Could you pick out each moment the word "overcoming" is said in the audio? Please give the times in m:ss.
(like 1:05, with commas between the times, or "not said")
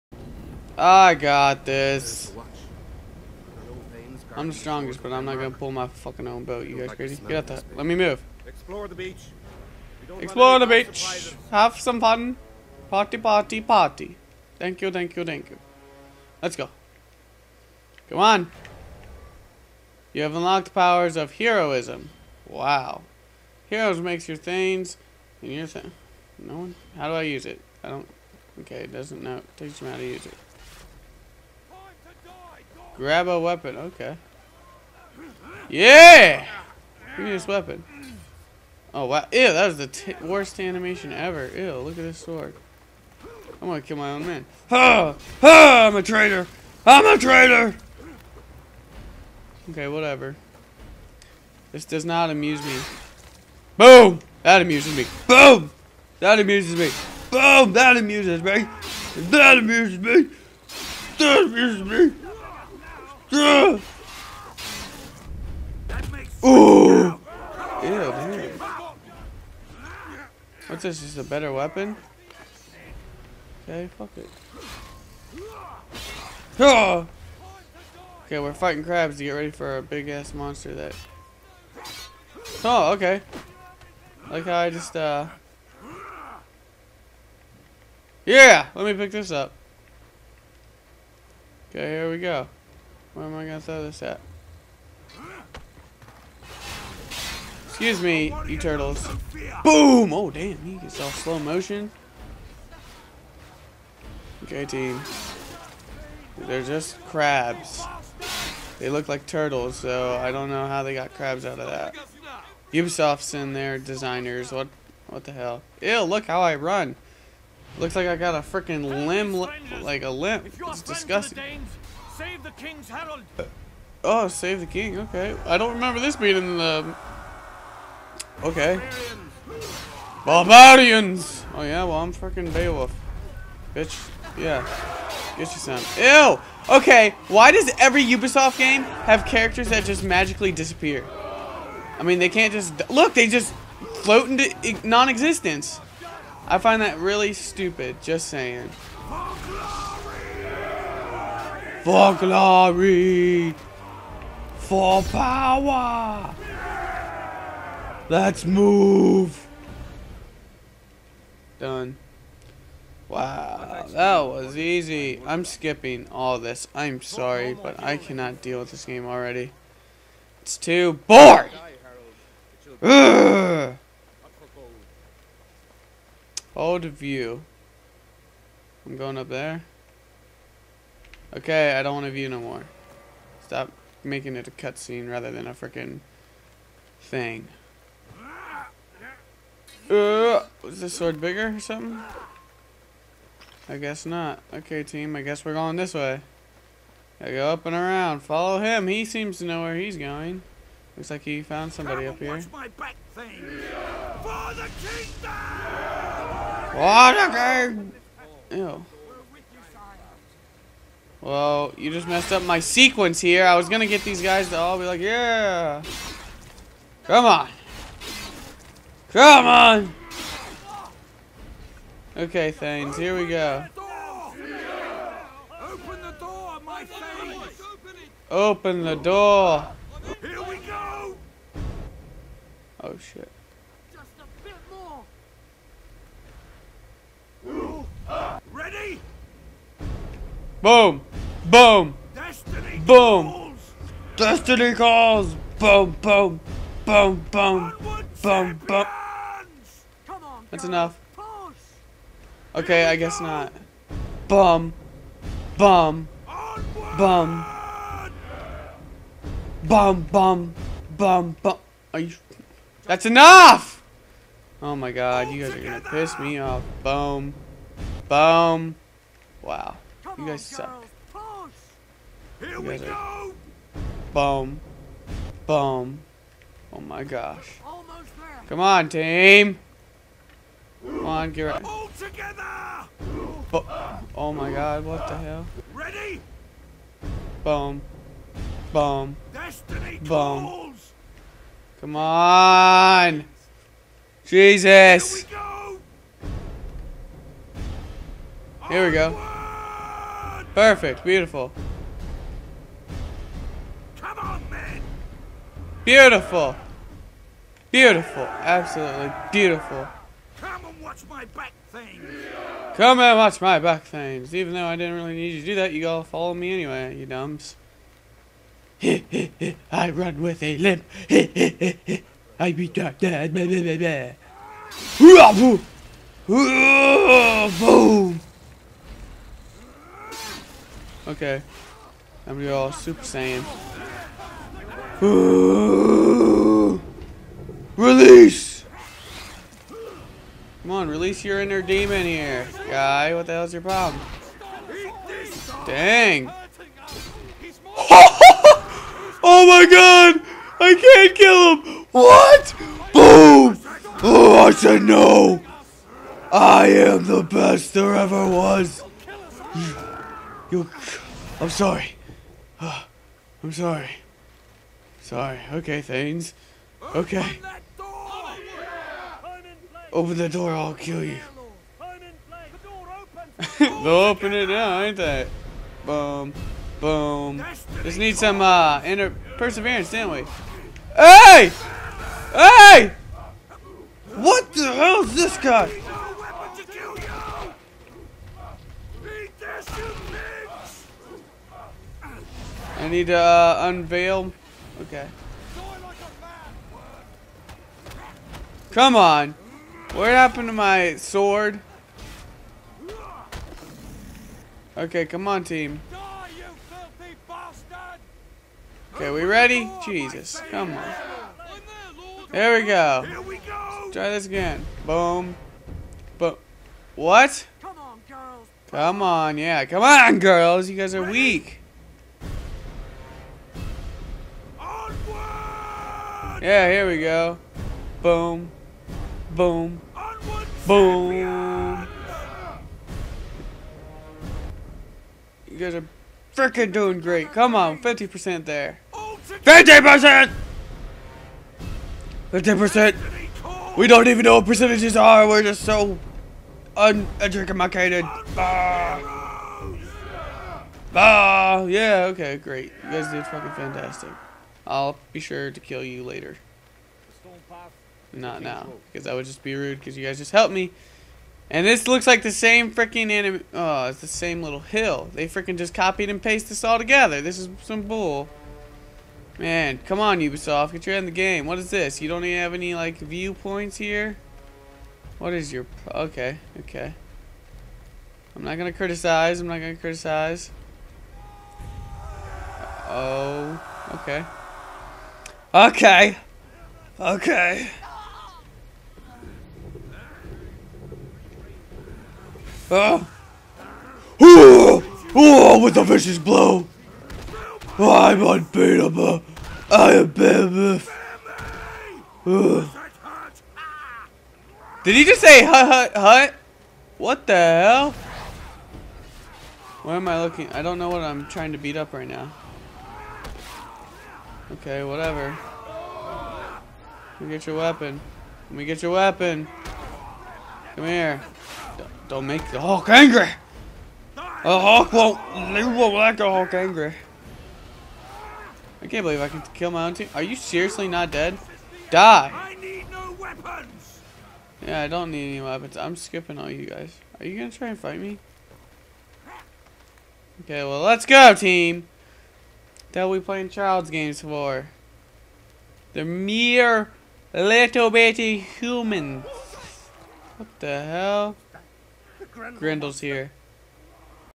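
not said.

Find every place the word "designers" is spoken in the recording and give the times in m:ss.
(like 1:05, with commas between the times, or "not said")
1:53.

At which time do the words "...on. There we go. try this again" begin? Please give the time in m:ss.
6:50.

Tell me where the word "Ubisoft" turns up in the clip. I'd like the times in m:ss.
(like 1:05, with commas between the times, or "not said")
1:52, 2:18, 7:50.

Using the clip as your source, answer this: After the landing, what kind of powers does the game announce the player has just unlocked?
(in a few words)
Powers of heroism.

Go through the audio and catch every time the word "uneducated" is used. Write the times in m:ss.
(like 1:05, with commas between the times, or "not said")
7:26.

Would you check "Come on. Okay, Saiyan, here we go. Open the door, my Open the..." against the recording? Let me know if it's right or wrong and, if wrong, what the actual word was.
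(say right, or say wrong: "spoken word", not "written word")
wrong: "Thanes", not "Saiyan".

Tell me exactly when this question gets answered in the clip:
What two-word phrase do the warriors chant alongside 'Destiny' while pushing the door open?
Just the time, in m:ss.
4:04.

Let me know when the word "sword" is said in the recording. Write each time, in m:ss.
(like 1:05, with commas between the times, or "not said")
0:42, 3:10, 6:40.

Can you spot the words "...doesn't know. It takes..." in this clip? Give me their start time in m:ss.
0:28.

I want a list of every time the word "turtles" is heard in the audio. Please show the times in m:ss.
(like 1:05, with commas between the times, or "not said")
1:38, 1:49.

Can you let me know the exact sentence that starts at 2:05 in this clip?
I don't remember this being in the.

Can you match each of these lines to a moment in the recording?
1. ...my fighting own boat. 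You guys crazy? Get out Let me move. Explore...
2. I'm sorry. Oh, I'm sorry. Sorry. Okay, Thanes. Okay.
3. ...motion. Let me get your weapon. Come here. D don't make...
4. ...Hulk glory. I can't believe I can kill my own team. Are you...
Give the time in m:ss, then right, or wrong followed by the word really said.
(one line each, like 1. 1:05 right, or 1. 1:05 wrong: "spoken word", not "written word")
1. 0:05 wrong: "fucking", not "fighting"
2. 6:01 right
3. 8:37 wrong: "weapon", not "motion"
4. 8:46 wrong: "angry", not "glory".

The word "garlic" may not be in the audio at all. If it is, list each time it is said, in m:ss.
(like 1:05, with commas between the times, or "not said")
not said.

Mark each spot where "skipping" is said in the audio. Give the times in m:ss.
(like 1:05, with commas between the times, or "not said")
2:45, 8:55.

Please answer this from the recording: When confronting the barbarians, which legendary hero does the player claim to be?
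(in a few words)
Beowulf.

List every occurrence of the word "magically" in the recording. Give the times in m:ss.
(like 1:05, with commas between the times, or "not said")
2:20.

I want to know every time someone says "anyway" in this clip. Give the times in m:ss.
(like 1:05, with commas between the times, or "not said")
5:16.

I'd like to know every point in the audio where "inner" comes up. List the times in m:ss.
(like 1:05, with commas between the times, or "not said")
5:41, 6:18.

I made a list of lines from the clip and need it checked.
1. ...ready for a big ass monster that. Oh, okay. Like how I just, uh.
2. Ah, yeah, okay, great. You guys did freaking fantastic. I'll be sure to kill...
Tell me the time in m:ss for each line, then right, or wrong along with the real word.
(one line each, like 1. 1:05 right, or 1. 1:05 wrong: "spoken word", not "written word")
1. 1:19 right
2. 7:30 wrong: "fucking", not "freaking".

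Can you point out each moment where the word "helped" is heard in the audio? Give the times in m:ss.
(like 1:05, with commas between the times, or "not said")
7:40.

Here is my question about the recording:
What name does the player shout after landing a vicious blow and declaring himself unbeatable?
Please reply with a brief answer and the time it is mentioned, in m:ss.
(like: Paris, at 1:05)
Behemoth, at 8:19.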